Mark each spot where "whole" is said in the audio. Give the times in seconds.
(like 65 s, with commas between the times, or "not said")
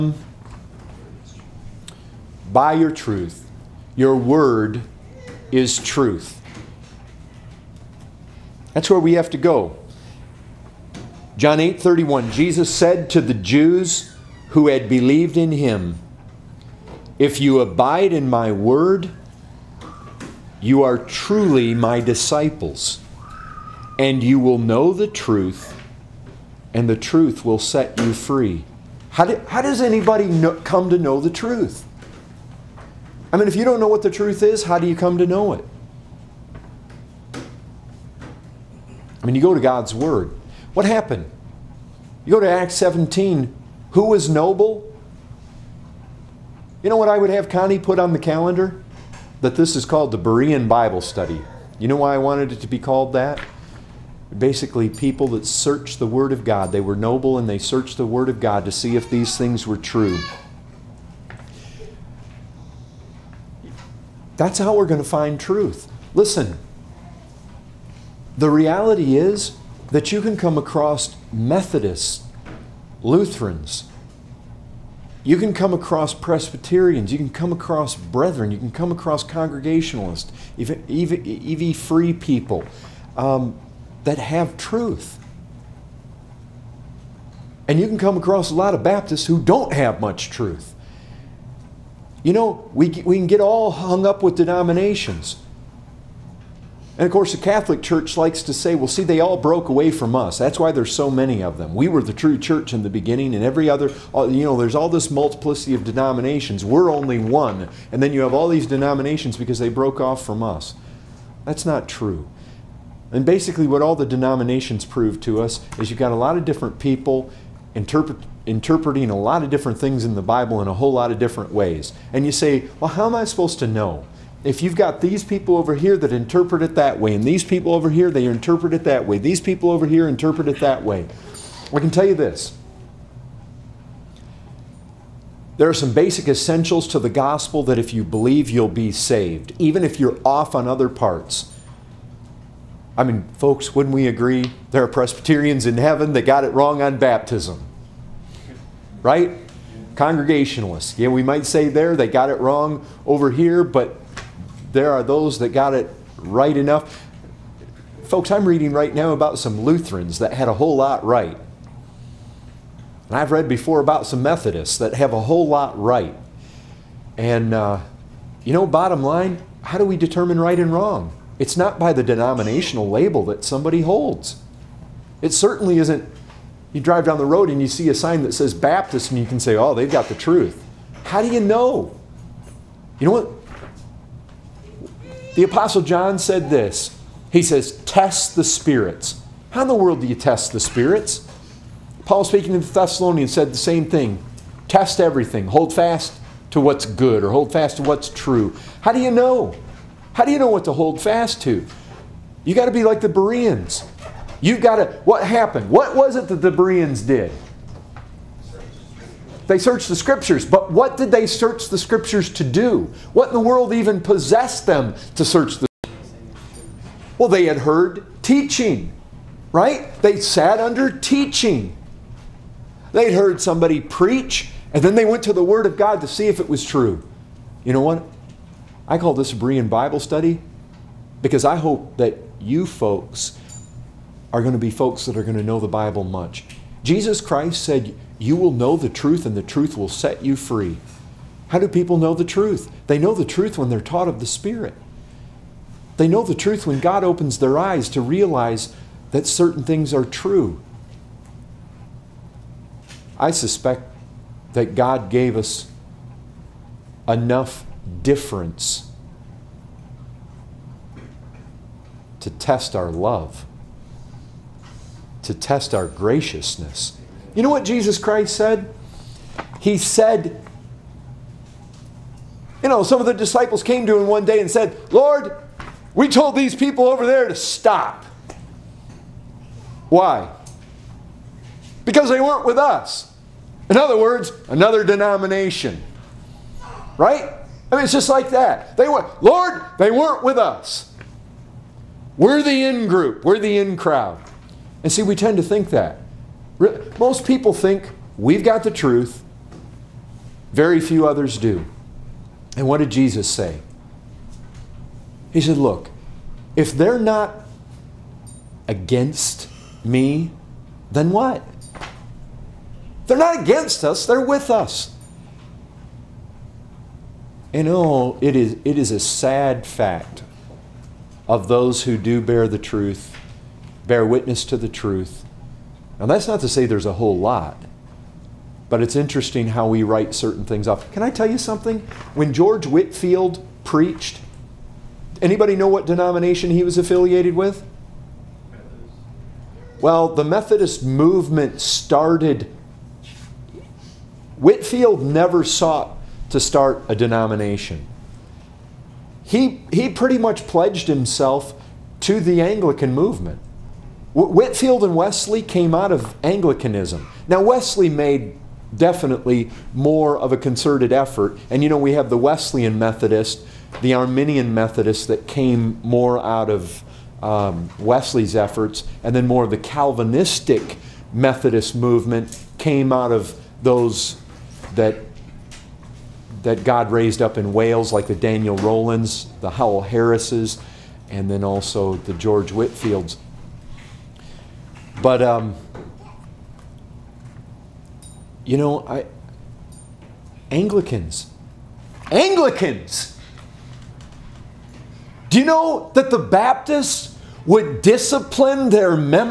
120 s, 160 s, 165 s, 326 s.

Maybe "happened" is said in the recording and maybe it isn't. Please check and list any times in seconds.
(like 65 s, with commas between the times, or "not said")
40 s, 205 s.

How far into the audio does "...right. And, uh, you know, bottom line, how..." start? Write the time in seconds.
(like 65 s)
165 s.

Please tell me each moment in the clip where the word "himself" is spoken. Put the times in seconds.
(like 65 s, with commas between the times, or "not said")
350 s.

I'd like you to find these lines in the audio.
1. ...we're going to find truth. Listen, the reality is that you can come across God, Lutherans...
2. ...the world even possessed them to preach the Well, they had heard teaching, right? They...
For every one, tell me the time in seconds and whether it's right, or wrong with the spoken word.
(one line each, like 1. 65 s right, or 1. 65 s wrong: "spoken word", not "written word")
1. 64 s wrong: "Methodists", not "God"
2. 213 s wrong: "search", not "preach".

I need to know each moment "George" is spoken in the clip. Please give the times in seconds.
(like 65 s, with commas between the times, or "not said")
332 s, 382 s.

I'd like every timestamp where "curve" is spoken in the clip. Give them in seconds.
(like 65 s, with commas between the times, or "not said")
not said.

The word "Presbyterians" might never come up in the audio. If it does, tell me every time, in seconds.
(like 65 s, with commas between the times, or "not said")
76 s, 144 s.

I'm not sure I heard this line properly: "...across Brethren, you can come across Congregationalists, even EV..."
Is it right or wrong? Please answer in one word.
right.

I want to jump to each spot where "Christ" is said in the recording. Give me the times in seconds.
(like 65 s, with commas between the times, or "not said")
237 s, 267 s.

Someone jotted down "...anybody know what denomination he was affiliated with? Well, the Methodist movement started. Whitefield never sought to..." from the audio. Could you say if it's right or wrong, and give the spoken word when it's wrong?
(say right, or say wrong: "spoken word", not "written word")
right.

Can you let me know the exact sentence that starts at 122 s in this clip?
And you say, well, how am I supposed to know?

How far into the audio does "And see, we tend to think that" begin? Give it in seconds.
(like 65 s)
294 s.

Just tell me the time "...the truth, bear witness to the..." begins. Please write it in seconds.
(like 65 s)
322 s.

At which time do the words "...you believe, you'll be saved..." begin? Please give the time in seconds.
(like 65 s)
137 s.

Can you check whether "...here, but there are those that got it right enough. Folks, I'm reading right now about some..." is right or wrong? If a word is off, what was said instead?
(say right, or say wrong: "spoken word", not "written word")
right.